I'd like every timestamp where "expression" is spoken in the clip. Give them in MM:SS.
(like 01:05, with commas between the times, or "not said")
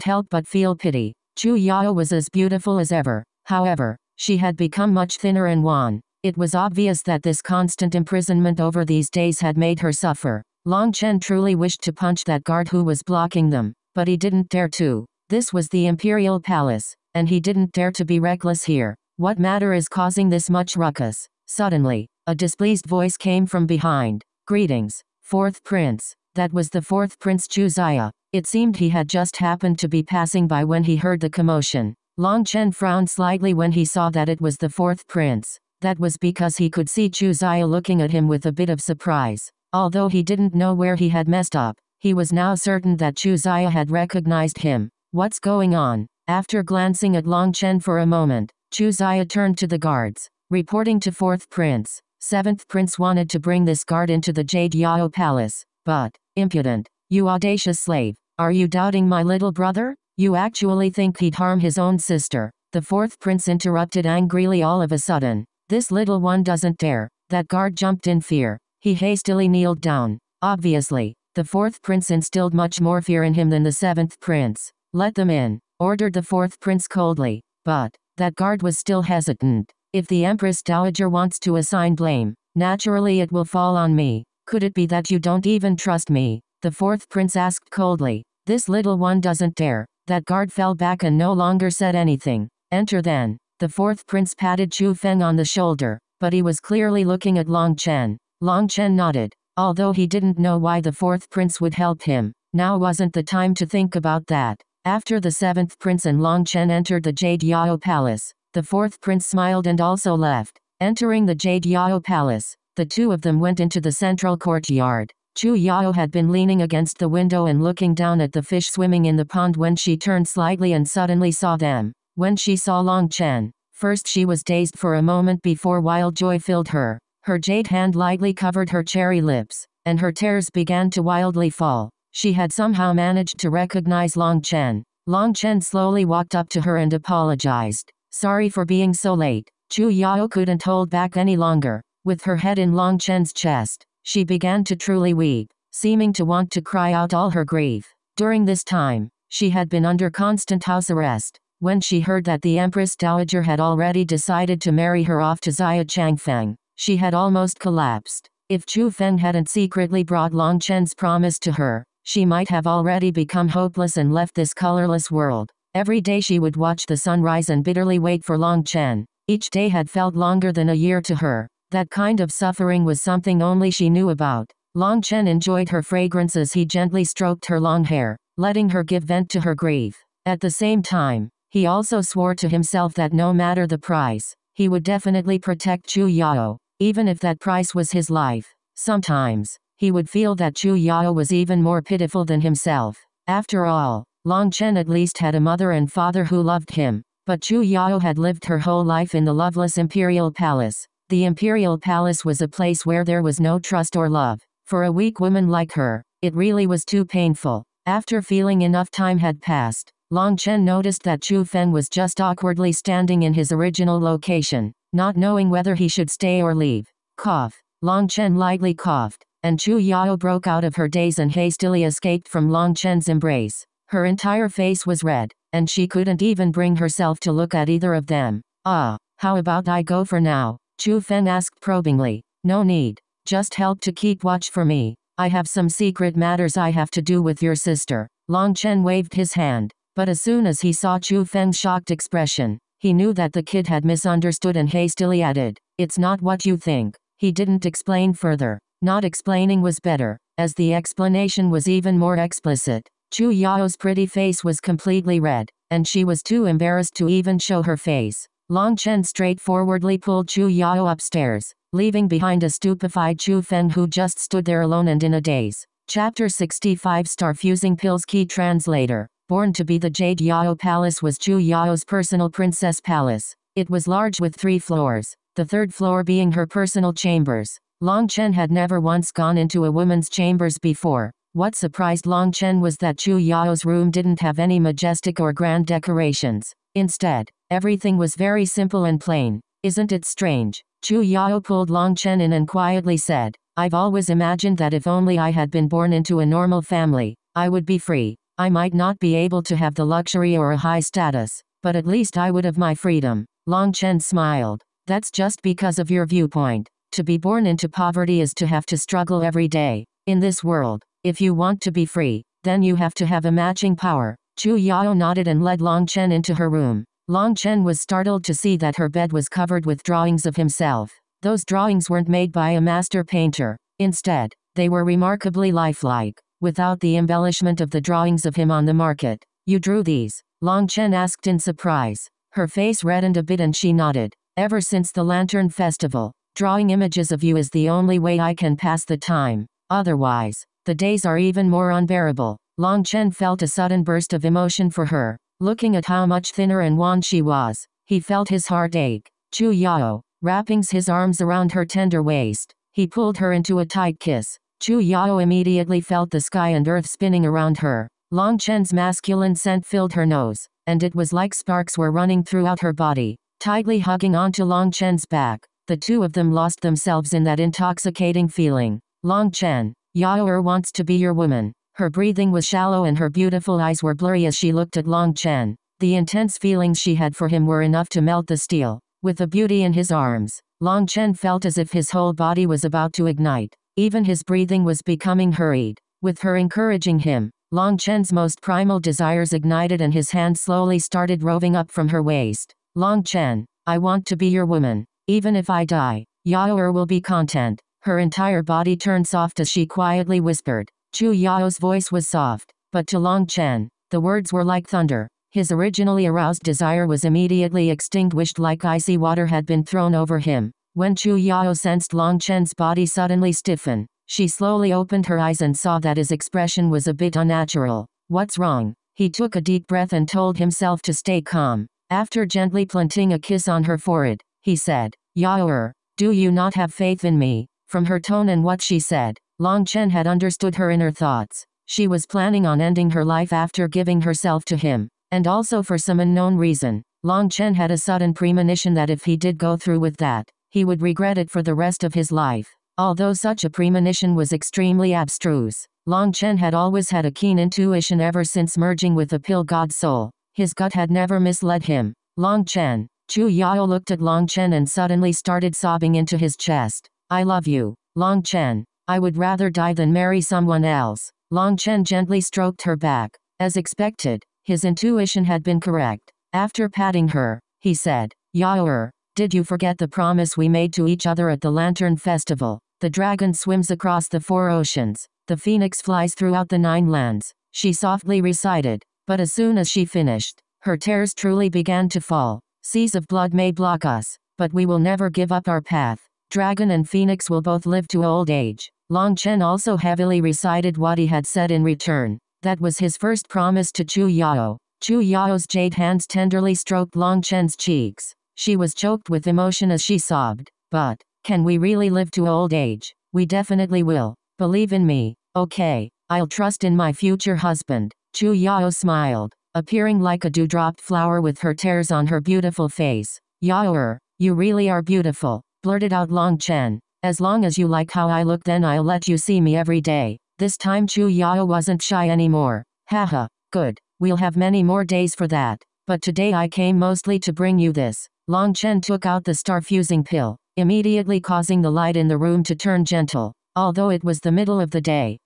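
04:01, 06:56.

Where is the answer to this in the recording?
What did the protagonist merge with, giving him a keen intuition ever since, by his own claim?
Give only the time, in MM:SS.
07:29.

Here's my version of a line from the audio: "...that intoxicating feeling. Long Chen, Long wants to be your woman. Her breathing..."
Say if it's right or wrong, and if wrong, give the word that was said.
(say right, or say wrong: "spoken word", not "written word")
wrong: "Yaoer", not "Long".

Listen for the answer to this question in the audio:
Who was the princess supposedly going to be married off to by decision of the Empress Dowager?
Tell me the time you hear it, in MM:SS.
02:35.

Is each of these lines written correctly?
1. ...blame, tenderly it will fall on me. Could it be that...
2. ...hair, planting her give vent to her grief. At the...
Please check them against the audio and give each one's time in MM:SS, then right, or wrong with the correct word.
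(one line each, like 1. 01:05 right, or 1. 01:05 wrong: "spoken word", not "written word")
1. 01:21 wrong: "naturally", not "tenderly"
2. 02:57 wrong: "letting", not "planting".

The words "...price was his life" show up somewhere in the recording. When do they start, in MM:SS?
03:07.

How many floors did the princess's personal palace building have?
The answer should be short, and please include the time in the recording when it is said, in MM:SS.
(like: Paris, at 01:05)
3, at 04:34.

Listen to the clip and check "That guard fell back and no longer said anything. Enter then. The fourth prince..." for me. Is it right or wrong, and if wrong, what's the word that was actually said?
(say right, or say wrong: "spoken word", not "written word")
right.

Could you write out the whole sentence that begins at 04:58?
I might not be able to have the luxury or a high status, but at least I would have my freedom.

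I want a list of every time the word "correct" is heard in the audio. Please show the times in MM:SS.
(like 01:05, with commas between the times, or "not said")
07:45.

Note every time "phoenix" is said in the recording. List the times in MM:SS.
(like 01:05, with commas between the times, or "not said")
07:55, 08:06.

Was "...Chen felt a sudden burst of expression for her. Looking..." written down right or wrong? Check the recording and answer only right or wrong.
wrong.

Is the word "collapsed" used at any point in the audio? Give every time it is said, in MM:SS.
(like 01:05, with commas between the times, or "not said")
02:37.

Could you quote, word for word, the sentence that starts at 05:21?
Those drawings weren't made by a master painter.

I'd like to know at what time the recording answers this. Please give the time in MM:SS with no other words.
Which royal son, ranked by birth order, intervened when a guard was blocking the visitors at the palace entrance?
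00:26.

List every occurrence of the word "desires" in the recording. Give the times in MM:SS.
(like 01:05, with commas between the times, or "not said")
06:28, 06:46.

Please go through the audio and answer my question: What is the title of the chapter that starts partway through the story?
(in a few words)
Star Fusing Pills.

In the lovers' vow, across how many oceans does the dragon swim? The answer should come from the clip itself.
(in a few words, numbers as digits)
4.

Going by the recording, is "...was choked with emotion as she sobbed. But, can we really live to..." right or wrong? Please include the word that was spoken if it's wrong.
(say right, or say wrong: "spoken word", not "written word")
right.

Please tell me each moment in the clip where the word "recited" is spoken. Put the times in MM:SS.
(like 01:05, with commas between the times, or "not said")
07:58, 08:10.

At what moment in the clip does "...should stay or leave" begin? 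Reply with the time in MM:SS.
03:35.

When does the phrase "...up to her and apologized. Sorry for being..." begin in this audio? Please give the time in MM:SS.
02:16.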